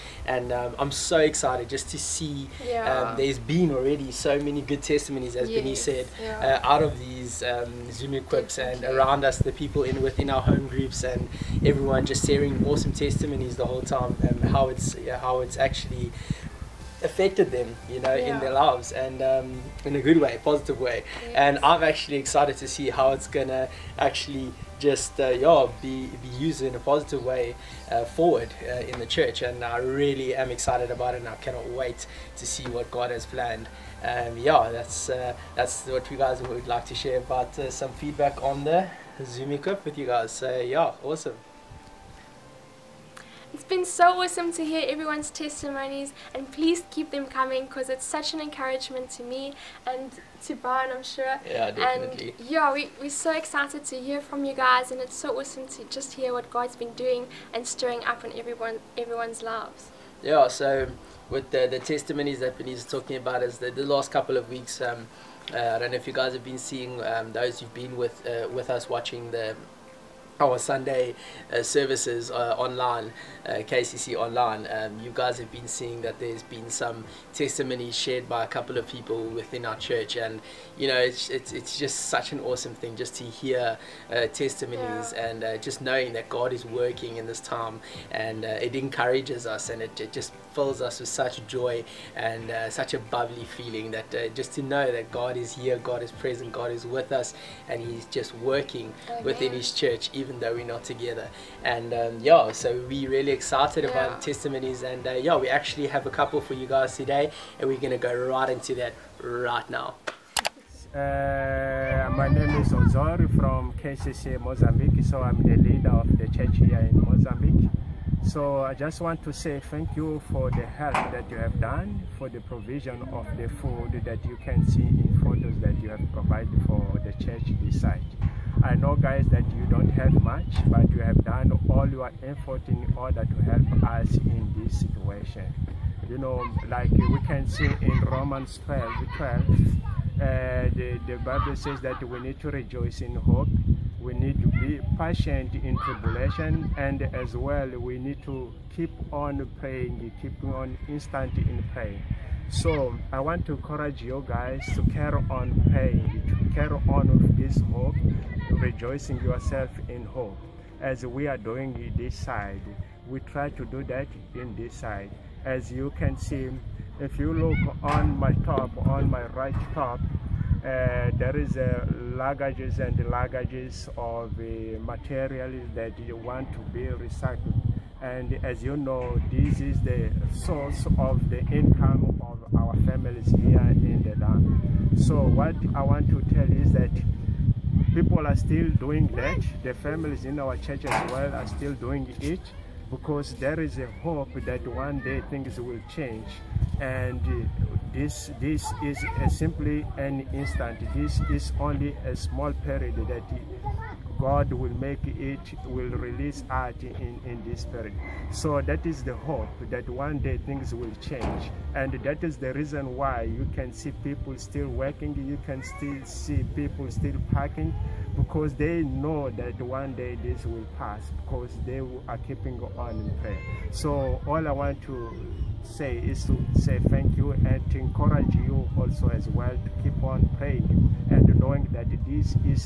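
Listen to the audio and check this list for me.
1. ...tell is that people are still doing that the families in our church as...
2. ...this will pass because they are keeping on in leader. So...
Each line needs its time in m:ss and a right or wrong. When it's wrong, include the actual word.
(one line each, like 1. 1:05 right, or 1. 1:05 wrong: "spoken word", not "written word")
1. 3:06 right
2. 3:40 wrong: "prayer", not "leader".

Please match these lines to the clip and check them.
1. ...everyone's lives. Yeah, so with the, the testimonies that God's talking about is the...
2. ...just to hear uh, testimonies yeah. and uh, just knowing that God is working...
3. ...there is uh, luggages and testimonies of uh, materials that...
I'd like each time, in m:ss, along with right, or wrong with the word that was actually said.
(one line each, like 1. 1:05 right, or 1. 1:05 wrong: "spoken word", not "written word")
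1. 0:58 wrong: "Benita", not "God"
2. 1:22 right
3. 2:51 wrong: "luggages", not "testimonies".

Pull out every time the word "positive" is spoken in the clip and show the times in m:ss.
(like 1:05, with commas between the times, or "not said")
0:20, 0:26.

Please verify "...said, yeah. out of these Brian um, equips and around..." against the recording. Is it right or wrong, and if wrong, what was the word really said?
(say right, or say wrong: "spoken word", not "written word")
wrong: "Zoom", not "Brian".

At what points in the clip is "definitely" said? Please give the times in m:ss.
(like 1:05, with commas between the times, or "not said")
0:51.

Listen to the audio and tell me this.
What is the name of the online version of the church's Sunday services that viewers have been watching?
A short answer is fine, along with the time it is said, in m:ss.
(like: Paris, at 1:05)
KCC online, at 1:13.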